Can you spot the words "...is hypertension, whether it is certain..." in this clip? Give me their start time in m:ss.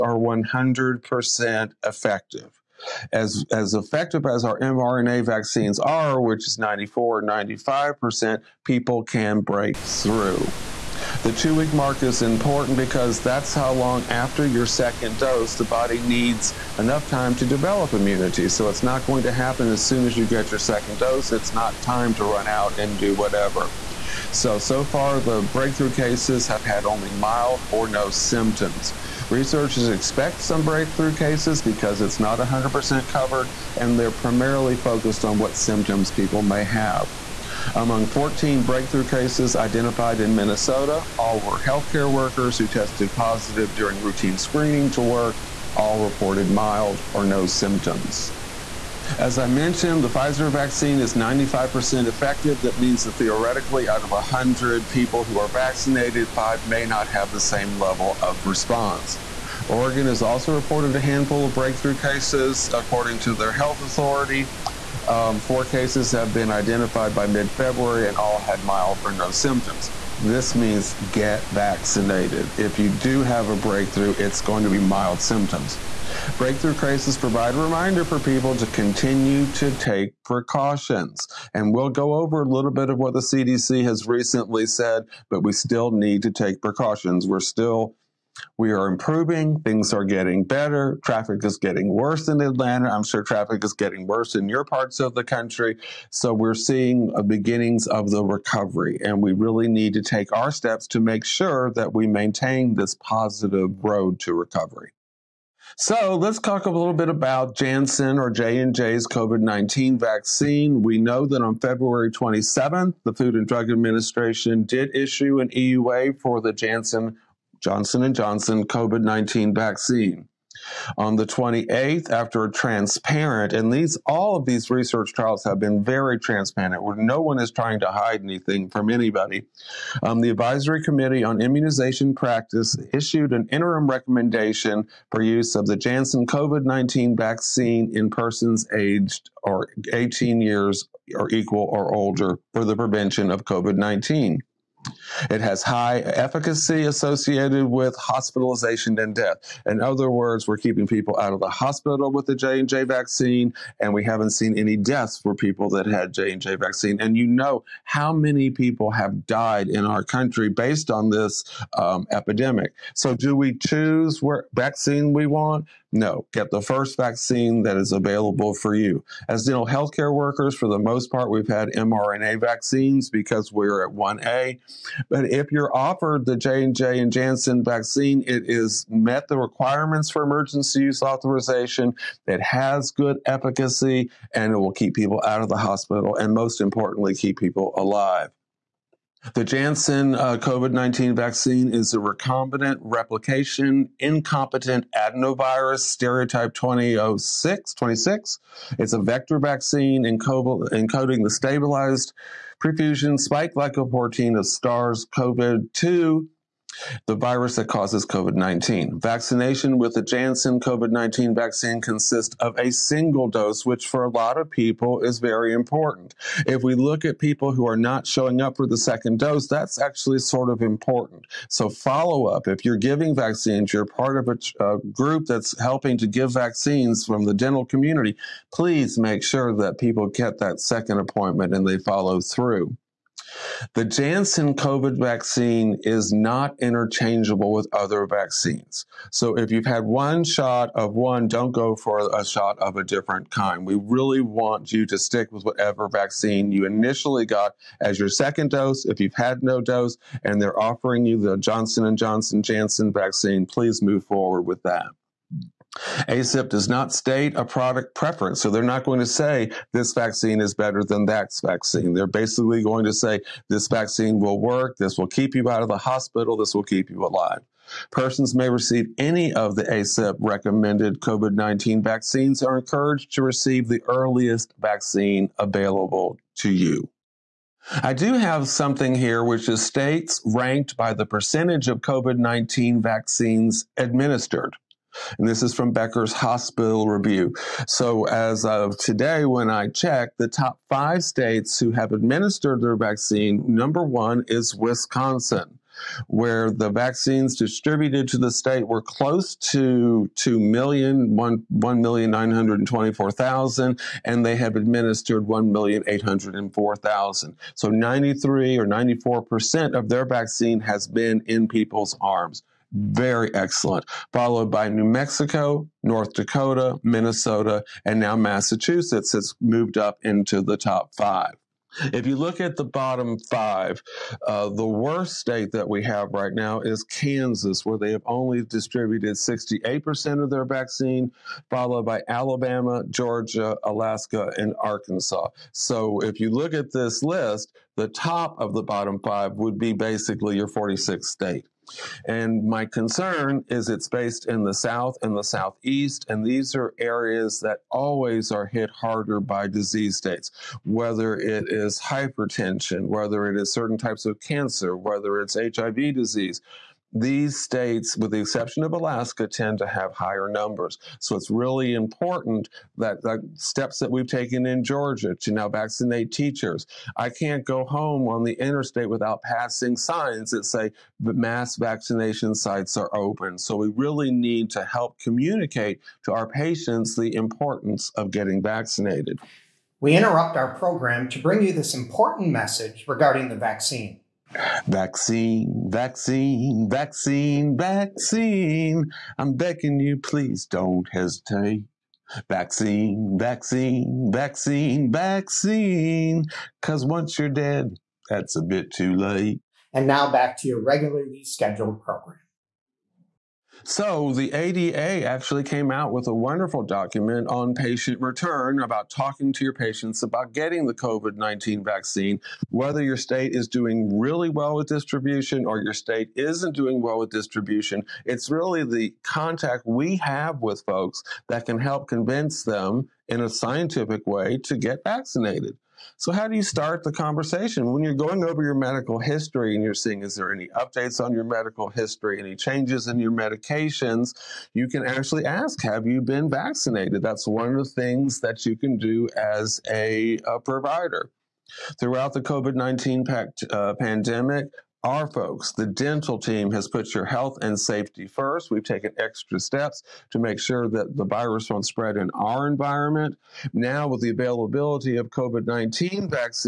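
5:51.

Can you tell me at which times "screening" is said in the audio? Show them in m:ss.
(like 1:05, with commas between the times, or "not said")
0:44.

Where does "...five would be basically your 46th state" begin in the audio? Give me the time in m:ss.
5:39.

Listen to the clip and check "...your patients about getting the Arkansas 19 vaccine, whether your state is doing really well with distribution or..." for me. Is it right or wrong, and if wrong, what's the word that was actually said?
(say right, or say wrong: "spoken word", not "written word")
wrong: "COVID", not "Arkansas".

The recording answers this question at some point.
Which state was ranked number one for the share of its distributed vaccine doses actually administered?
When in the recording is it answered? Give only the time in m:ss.
4:54.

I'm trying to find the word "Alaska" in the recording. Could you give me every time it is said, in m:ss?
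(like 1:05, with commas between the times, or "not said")
5:33, 5:58.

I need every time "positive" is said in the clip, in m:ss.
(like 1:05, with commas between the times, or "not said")
0:43, 1:42.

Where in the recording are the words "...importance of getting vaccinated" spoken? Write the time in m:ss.
6:17.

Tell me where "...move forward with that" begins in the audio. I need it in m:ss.
4:13.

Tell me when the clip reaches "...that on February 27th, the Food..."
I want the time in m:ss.
1:51.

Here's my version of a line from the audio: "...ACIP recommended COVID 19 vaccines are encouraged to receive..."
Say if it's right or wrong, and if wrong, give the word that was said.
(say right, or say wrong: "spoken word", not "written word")
right.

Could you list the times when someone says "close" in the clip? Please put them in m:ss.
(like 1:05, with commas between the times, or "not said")
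4:58.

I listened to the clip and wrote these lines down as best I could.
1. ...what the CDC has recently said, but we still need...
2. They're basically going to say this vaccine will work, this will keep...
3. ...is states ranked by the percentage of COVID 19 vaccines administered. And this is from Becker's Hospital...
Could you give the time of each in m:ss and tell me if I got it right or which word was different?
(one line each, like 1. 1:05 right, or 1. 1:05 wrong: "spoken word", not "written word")
1. 1:22 right
2. 4:21 right
3. 4:39 right.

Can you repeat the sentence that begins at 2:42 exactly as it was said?
So do we choose what vaccine we want?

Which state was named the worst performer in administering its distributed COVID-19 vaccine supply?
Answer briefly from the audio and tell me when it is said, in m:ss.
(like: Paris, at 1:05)
Kansas, at 5:26.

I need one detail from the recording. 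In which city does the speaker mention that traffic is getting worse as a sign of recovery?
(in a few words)
Atlanta.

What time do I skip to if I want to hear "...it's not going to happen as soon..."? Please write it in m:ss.
0:18.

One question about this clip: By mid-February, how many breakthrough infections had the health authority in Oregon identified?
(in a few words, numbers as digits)
4.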